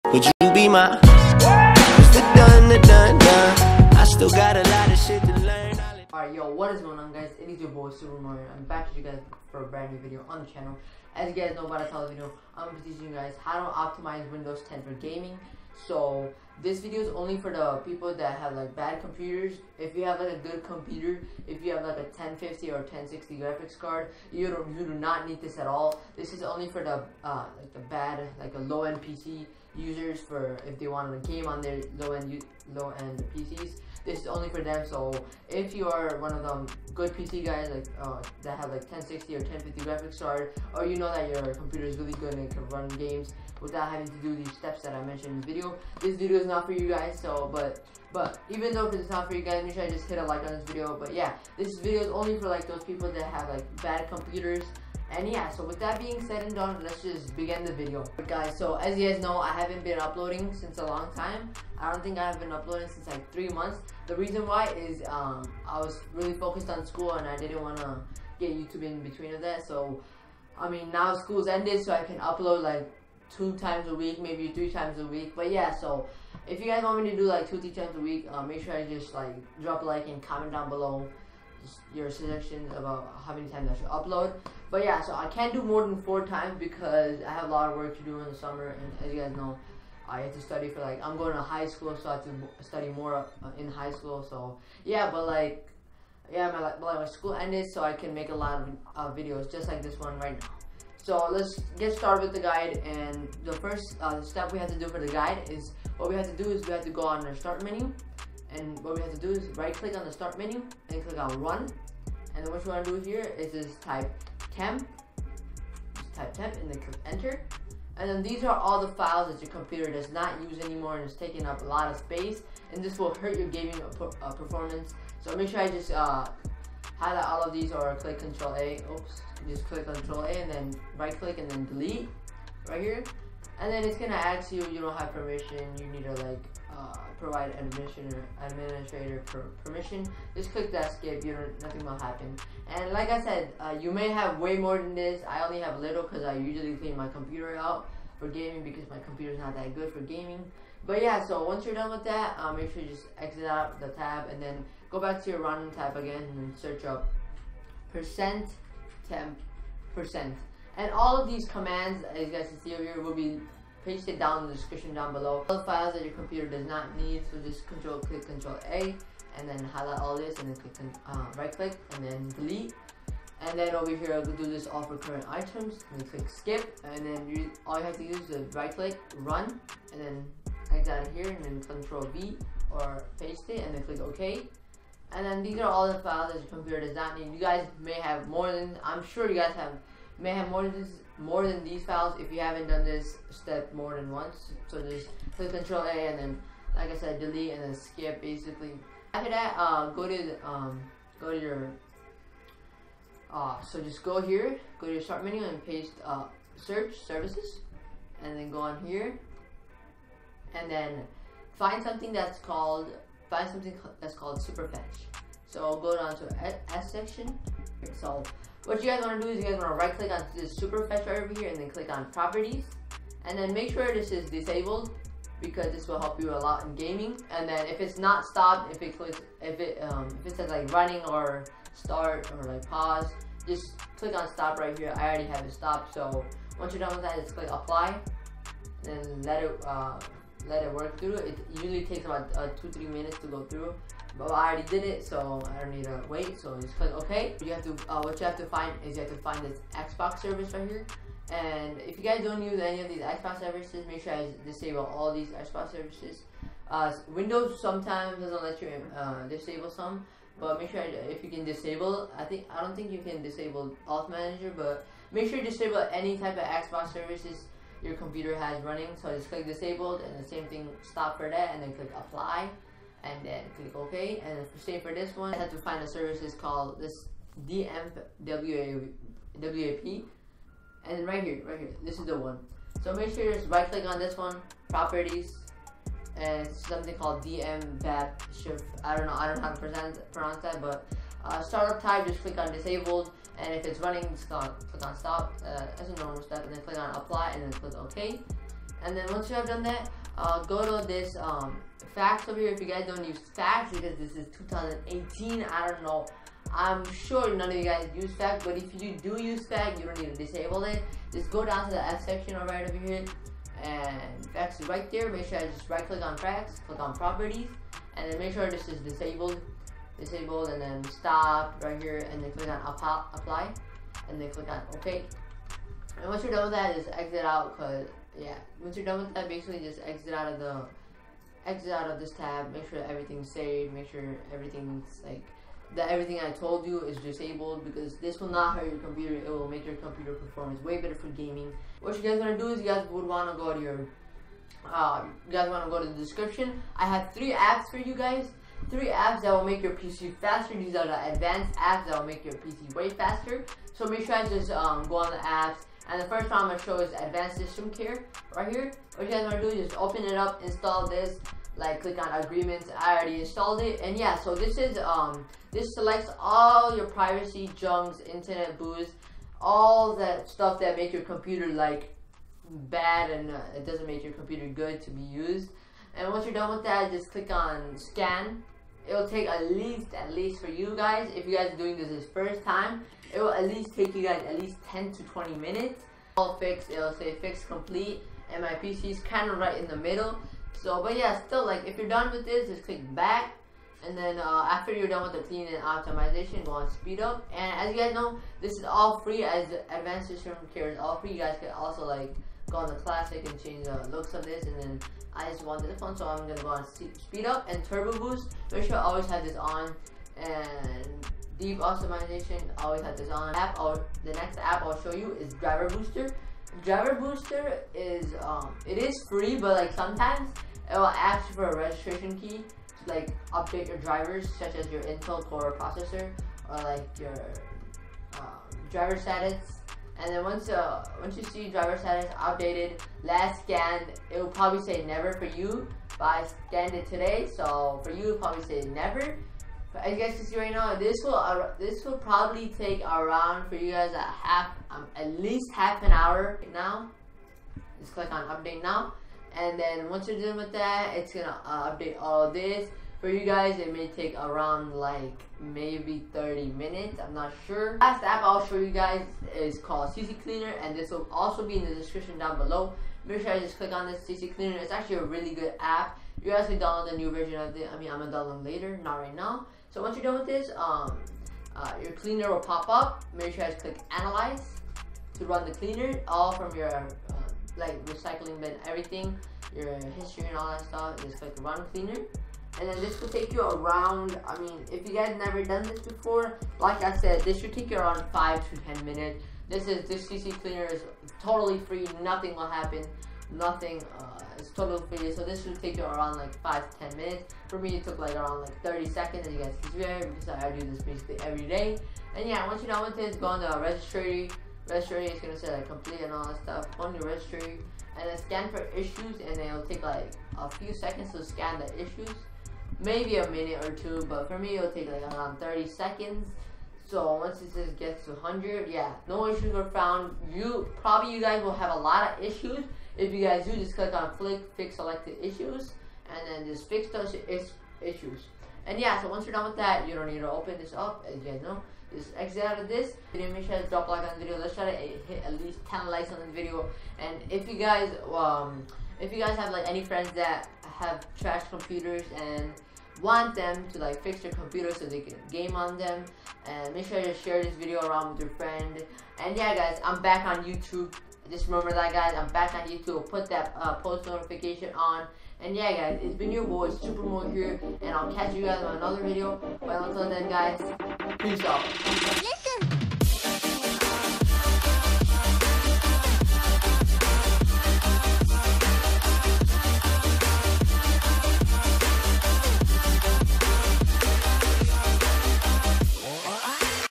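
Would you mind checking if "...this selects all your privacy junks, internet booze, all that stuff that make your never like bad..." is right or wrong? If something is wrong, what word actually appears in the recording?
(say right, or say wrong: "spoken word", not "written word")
wrong: "computer", not "never".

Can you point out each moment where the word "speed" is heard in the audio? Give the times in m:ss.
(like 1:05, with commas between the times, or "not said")
6:36, 6:47.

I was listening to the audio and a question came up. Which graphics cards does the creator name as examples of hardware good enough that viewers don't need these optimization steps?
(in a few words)
1050 or 1060.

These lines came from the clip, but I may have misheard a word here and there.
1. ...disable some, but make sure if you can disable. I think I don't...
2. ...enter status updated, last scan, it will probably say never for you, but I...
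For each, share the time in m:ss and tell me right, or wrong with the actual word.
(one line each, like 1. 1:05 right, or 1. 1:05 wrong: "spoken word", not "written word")
1. 4:19 right
2. 7:11 wrong: "driver", not "enter".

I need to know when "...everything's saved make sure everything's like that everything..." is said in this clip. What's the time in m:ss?
5:32.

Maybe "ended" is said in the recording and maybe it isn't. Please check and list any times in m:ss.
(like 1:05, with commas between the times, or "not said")
1:11, 1:37.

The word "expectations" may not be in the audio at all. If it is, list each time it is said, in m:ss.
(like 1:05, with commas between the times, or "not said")
not said.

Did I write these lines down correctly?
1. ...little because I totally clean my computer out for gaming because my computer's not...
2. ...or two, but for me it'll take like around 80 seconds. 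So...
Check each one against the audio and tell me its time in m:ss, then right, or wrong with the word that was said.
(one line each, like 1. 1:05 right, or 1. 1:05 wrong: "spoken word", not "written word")
1. 2:25 wrong: "usually", not "totally"
2. 8:33 wrong: "30", not "80".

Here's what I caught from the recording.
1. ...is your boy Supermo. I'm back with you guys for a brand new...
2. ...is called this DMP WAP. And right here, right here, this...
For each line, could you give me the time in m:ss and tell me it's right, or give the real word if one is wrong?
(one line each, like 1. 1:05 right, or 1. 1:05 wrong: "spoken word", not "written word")
1. 0:07 right
2. 4:36 right.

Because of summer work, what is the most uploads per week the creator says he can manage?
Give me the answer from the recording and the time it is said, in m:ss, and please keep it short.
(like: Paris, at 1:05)
4, at 1:26.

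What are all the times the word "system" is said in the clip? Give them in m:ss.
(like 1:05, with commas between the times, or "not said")
5:57, 6:40.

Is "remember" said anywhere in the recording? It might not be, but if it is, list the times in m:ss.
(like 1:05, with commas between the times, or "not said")
9:11.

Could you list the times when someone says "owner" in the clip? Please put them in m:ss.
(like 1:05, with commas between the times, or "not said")
not said.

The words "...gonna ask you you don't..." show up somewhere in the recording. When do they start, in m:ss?
2:13.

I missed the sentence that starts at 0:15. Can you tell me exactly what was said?
So this video is only for the people that have like bad computers.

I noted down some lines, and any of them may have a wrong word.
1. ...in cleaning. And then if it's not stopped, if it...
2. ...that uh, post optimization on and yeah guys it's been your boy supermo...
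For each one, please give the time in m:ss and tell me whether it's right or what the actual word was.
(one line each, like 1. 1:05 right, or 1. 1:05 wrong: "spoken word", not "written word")
1. 3:46 wrong: "gaming", not "cleaning"
2. 9:13 wrong: "notification", not "optimization".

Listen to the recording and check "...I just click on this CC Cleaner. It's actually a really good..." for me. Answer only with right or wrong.
right.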